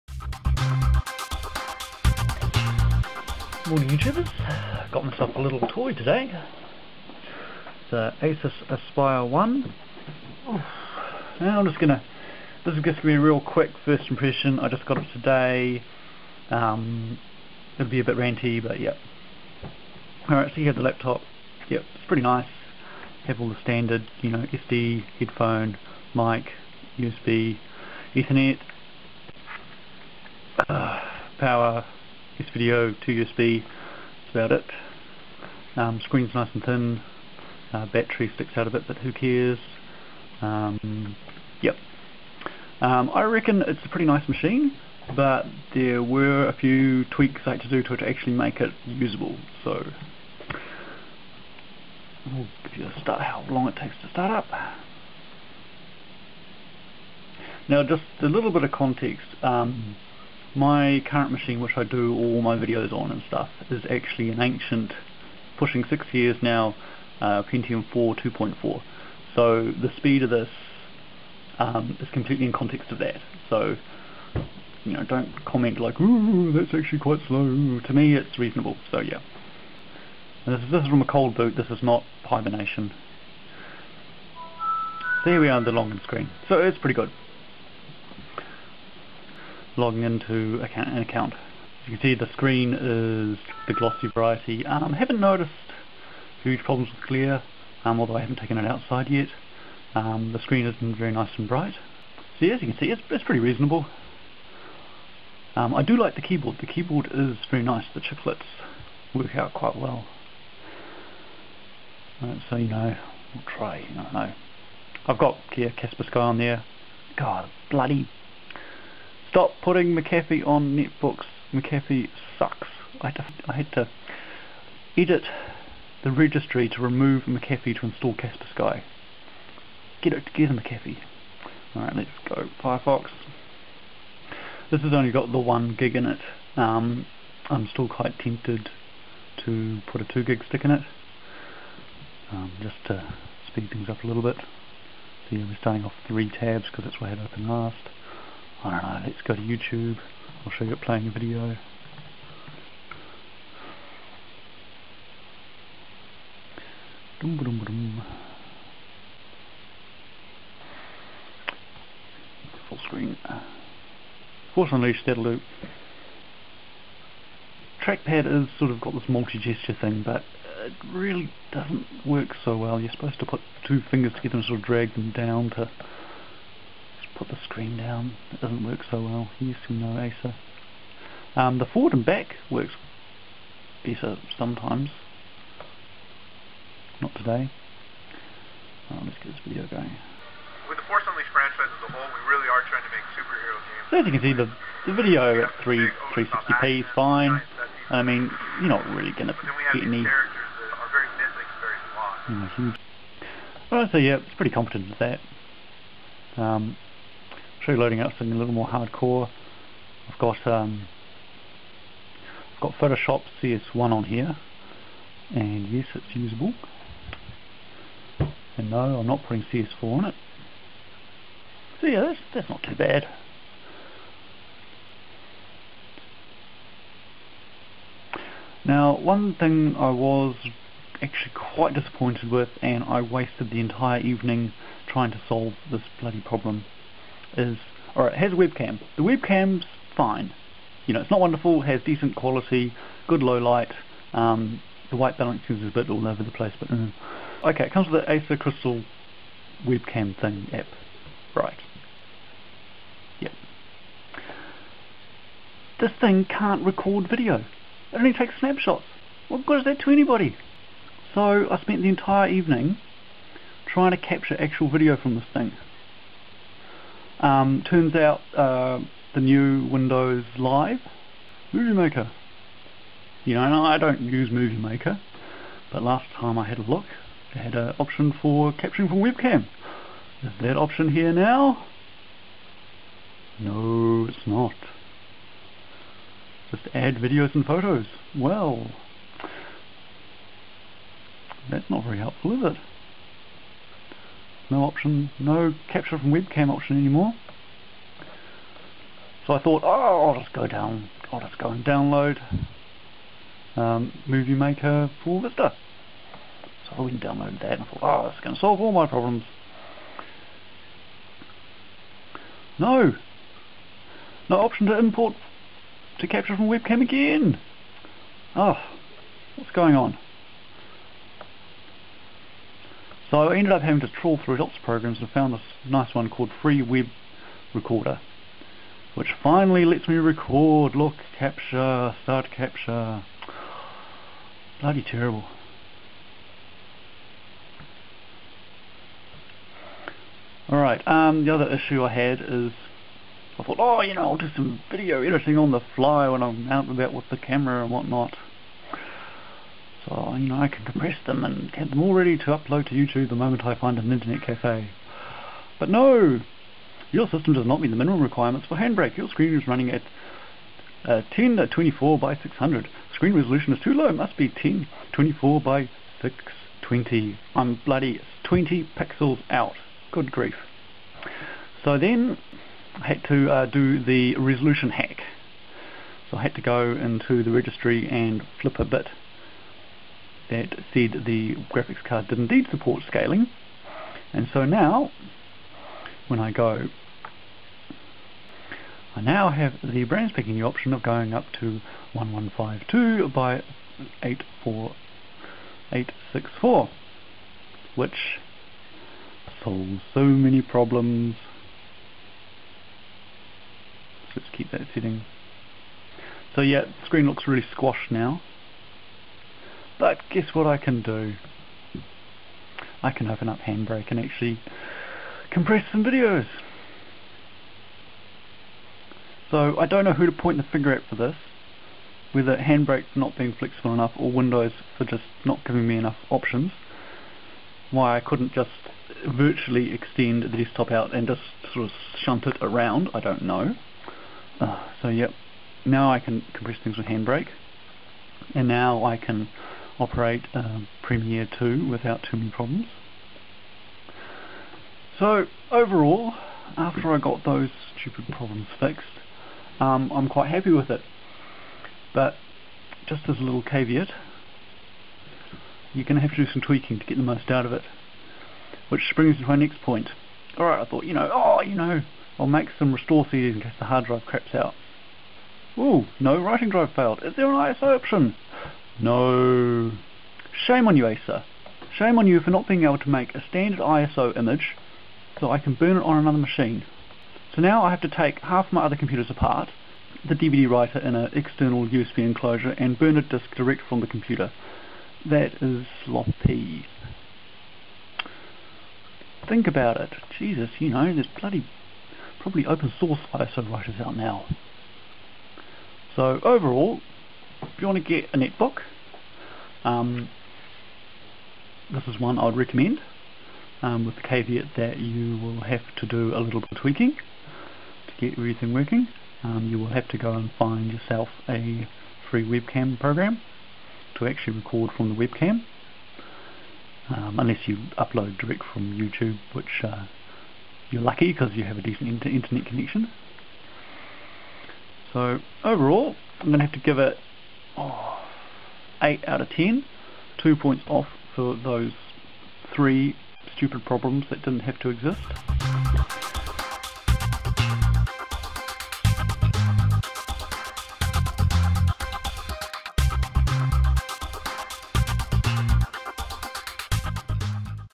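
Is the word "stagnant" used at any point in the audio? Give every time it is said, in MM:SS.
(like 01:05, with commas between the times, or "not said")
not said.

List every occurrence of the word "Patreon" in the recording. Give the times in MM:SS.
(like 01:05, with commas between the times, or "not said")
not said.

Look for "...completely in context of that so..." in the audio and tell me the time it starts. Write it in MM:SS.
01:12.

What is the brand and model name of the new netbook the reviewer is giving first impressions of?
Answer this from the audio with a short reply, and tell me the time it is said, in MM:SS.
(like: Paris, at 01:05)
Acer Aspire 1, at 00:08.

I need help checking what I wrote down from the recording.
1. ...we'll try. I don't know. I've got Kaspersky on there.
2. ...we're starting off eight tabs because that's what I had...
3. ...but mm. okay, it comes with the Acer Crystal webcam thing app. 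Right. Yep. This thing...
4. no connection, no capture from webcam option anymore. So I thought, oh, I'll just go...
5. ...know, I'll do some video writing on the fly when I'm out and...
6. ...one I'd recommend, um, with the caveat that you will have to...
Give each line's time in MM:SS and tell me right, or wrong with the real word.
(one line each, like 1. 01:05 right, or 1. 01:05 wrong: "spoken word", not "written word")
1. 01:53 right
2. 02:25 wrong: "three", not "eight"
3. 04:06 right
4. 04:54 wrong: "option", not "connection"
5. 05:43 wrong: "editing", not "writing"
6. 08:21 right.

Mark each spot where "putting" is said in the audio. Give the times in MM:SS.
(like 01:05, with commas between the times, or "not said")
01:59, 03:39.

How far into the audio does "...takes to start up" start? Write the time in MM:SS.
00:53.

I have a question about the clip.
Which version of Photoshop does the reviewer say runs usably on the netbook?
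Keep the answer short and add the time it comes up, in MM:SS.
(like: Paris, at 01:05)
CS1, at 03:33.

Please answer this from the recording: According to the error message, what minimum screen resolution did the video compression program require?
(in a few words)
1024 by 620.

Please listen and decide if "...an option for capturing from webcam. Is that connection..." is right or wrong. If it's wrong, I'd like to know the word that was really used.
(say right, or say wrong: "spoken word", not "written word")
wrong: "option", not "connection".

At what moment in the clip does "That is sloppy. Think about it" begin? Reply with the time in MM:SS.
08:05.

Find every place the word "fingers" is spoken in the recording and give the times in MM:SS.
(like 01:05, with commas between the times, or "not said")
02:53, 07:00.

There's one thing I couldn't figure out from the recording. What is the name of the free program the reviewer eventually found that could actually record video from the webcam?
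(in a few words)
Free Web Recorder.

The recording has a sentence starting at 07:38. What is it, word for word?
Which brings me to my next point.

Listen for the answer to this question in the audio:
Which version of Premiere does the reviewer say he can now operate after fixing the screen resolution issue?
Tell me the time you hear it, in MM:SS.
07:20.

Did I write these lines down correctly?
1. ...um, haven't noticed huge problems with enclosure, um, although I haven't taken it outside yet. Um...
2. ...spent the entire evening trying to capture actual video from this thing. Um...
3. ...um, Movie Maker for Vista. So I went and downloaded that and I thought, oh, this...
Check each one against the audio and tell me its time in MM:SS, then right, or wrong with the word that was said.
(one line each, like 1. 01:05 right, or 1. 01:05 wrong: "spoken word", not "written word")
1. 01:34 wrong: "glare", not "enclosure"
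2. 04:21 right
3. 05:03 right.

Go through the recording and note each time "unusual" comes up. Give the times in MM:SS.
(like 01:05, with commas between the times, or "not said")
not said.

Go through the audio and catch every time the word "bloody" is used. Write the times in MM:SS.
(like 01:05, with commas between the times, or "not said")
01:57, 03:55, 05:34, 06:07, 08:11.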